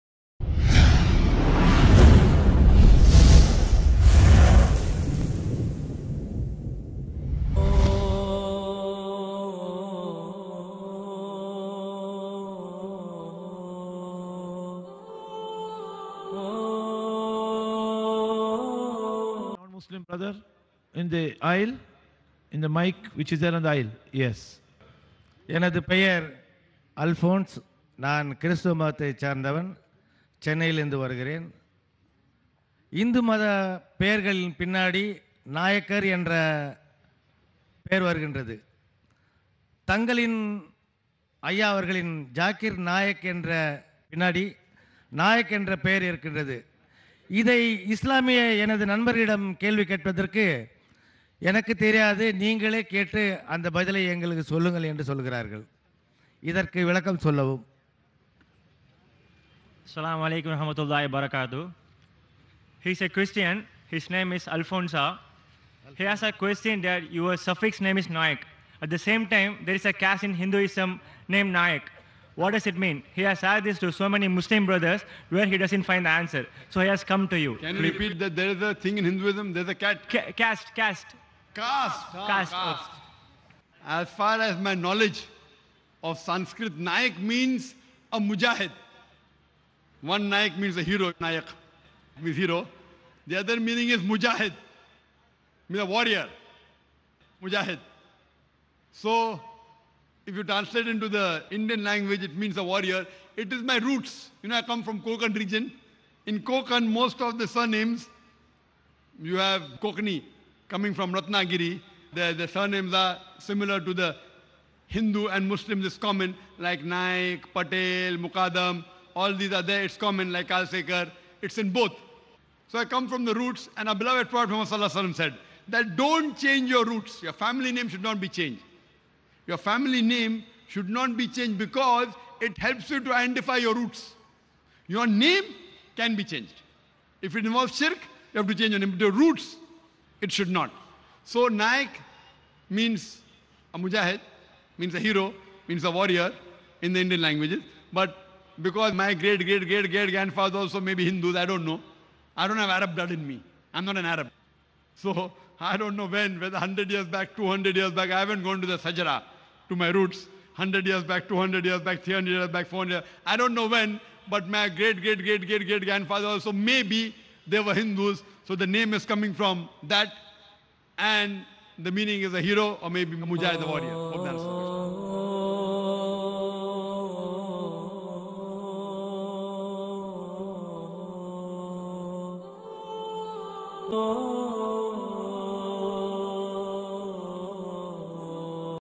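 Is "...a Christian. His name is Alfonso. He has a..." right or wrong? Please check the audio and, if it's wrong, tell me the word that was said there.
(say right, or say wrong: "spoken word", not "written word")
right.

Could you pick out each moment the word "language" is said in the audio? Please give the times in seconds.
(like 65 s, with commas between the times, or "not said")
101 s, 147 s.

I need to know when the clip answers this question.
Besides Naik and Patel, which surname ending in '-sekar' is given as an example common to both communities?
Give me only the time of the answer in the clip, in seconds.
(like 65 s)
120 s.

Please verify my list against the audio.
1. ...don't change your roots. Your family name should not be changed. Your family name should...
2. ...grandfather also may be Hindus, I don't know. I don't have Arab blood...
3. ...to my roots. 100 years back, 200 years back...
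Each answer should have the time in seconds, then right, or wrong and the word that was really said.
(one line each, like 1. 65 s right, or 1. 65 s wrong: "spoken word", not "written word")
1. 125 s right
2. 150 s right
3. 159 s right.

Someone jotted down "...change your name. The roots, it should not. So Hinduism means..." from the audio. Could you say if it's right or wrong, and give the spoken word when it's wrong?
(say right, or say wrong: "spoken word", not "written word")
wrong: "Naik", not "Hinduism".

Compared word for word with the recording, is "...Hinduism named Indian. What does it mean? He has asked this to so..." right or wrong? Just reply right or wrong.
wrong.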